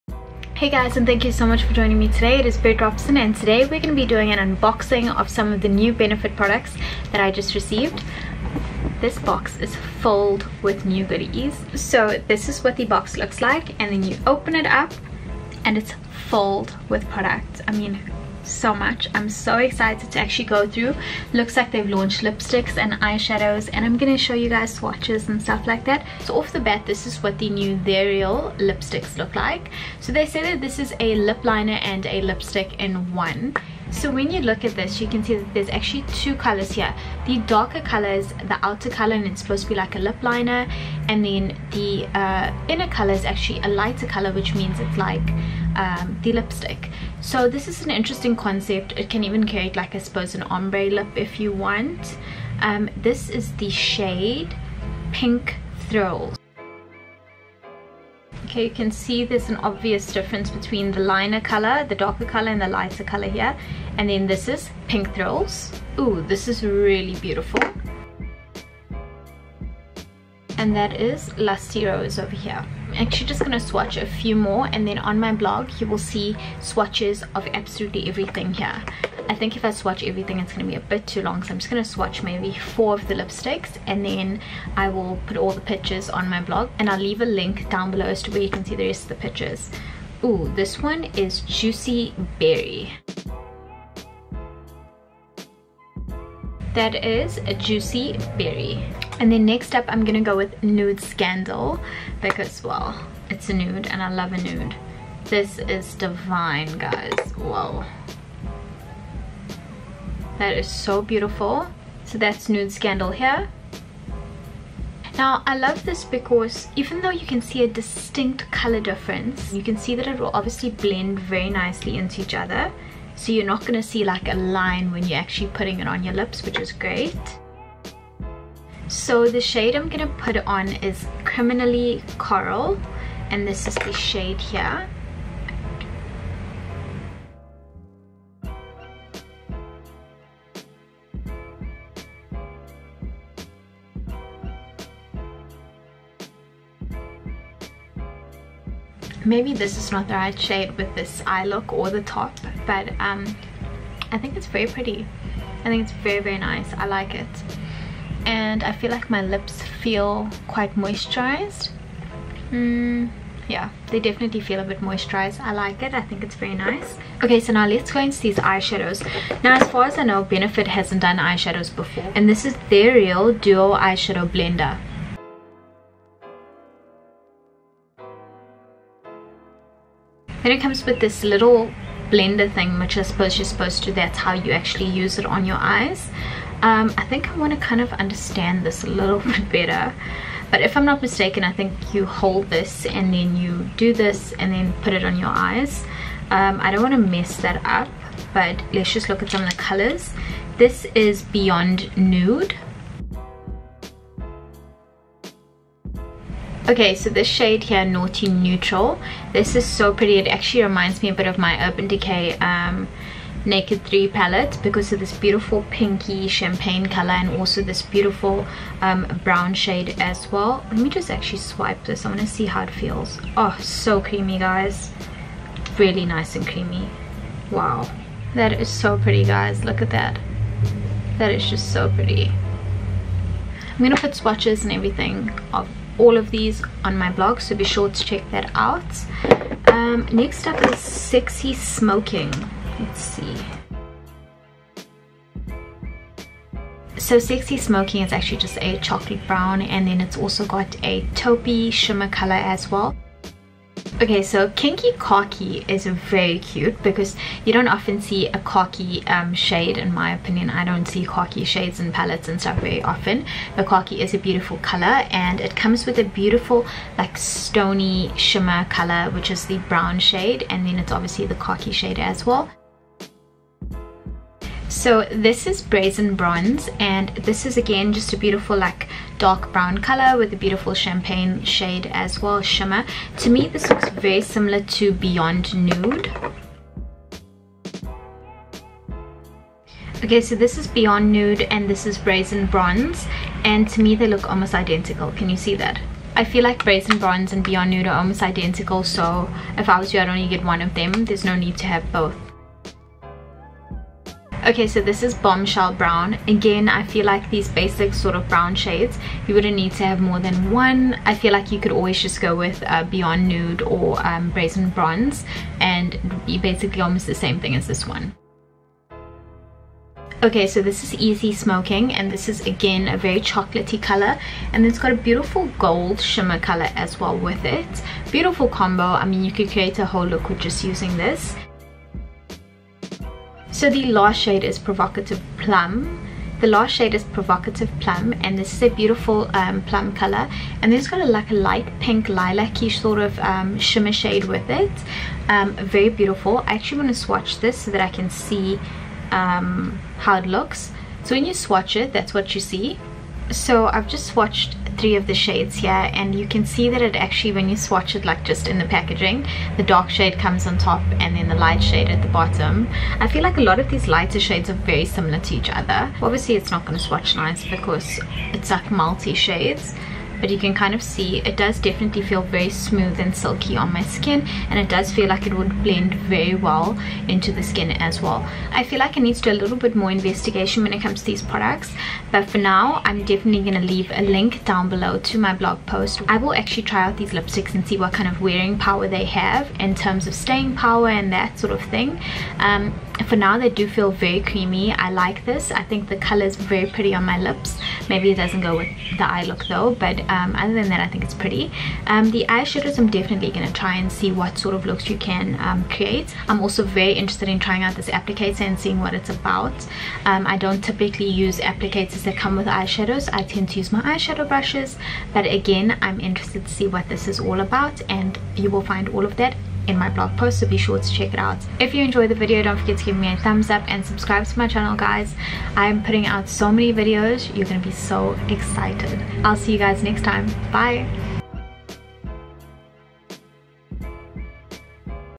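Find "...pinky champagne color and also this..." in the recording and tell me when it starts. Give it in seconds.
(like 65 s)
215 s.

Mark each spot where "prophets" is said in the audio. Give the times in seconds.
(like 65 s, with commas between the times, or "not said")
not said.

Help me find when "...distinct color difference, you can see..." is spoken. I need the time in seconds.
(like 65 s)
117 s.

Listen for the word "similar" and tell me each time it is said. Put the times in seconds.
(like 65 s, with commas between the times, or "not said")
284 s, 364 s.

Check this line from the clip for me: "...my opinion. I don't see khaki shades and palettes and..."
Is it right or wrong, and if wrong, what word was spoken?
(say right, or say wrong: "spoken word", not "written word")
right.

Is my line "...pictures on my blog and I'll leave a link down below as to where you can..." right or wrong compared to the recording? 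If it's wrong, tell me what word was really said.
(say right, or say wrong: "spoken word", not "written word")
right.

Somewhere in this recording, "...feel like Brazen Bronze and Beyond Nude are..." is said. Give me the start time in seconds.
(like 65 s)
296 s.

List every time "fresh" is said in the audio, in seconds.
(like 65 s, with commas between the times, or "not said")
not said.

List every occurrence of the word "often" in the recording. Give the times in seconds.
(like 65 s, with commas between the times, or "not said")
257 s, 262 s.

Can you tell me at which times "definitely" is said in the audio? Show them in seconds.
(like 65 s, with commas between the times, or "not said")
163 s, 371 s, 383 s, 402 s.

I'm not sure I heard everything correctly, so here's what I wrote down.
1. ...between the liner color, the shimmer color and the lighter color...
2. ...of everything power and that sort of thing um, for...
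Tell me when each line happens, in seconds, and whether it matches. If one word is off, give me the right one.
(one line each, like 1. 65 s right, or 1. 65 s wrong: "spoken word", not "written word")
1. 60 s wrong: "darker", not "shimmer"
2. 390 s wrong: "staying", not "everything".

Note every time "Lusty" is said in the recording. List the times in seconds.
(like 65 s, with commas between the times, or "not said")
71 s.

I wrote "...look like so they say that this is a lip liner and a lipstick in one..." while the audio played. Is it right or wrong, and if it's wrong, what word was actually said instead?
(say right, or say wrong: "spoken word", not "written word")
right.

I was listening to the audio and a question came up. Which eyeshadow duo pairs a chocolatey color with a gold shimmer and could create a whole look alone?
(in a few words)
Easy Smoking.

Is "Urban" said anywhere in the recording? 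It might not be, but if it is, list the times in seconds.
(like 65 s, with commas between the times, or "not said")
211 s.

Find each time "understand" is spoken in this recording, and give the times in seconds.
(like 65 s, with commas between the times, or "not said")
187 s.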